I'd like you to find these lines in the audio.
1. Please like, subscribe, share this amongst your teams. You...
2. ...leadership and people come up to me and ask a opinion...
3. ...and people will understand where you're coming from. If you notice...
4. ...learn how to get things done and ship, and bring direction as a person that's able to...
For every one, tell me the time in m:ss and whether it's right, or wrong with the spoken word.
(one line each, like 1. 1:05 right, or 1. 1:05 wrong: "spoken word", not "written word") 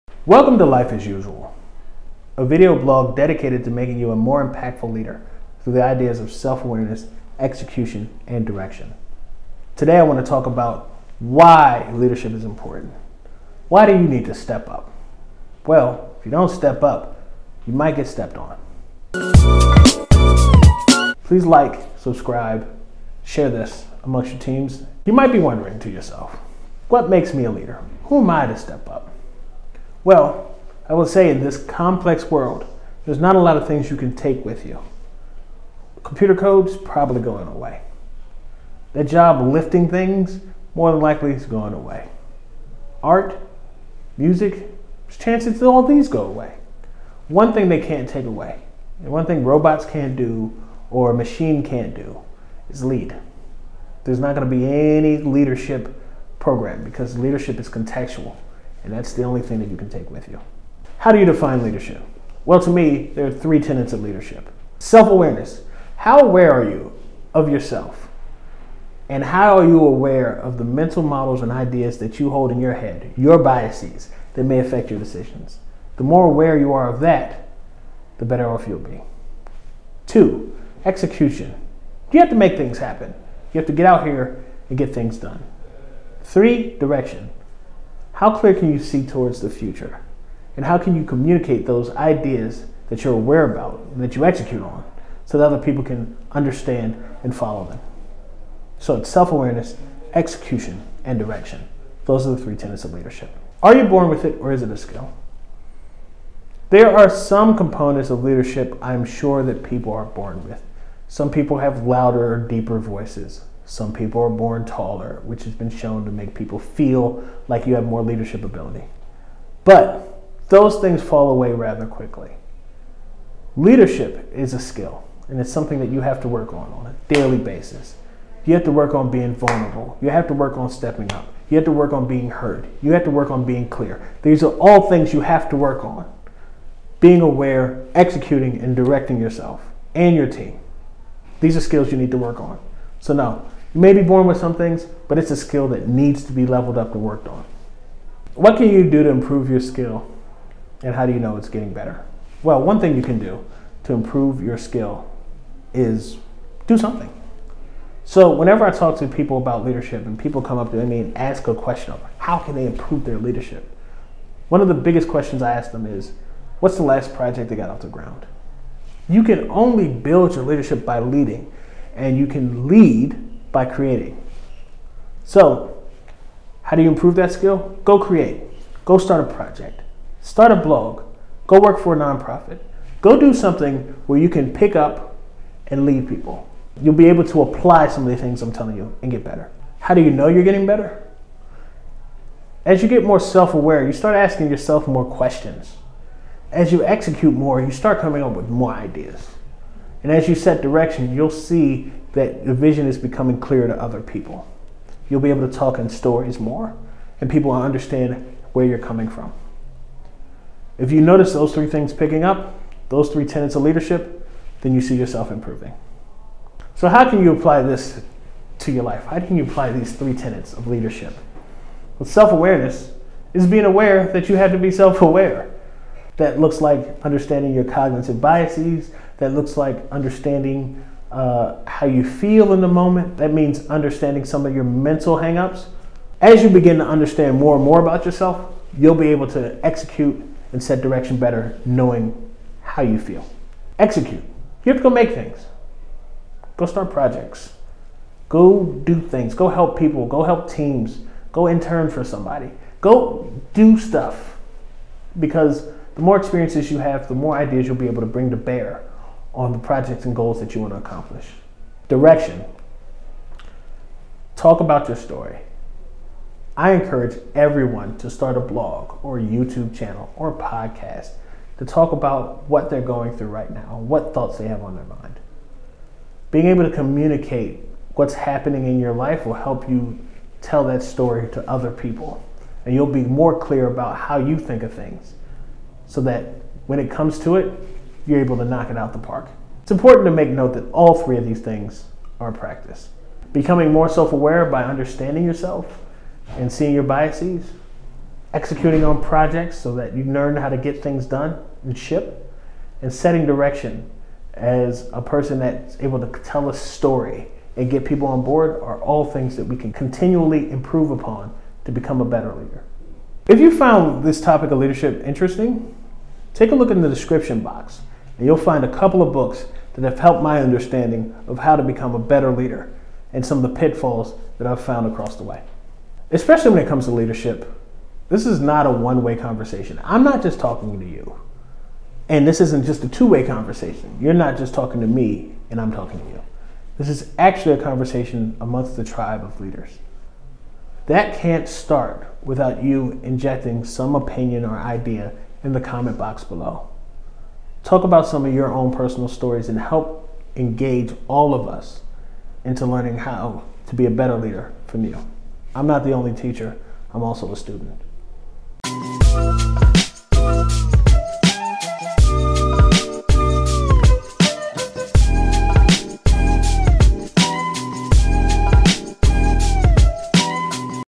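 1. 0:21 right
2. 2:39 wrong: "question", not "opinion"
3. 3:27 right
4. 5:00 wrong: "setting", not "bring".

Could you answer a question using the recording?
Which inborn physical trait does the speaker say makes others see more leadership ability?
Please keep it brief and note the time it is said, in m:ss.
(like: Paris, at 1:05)
Taller, at 1:54.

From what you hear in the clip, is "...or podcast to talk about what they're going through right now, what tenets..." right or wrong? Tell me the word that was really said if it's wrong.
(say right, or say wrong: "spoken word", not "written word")
wrong: "thoughts", not "tenets".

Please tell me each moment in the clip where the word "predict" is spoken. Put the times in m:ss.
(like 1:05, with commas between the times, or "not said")
not said.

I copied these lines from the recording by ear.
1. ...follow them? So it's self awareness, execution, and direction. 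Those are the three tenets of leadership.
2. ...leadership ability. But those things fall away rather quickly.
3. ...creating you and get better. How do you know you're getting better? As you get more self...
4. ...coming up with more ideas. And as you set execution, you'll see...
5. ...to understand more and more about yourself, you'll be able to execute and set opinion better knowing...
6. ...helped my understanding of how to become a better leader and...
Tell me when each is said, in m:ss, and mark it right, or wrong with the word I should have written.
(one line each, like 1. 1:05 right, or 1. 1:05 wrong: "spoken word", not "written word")
1. 1:37 right
2. 1:58 right
3. 3:08 wrong: "telling", not "creating"
4. 3:17 wrong: "direction", not "execution"
5. 3:56 wrong: "direction", not "opinion"
6. 5:19 right.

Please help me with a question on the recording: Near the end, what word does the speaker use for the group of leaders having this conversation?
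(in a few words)
Tribe.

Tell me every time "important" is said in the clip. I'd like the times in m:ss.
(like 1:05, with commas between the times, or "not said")
0:12, 4:49.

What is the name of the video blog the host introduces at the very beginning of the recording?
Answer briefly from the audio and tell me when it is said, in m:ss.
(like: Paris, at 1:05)
Life as Usual, at 0:00.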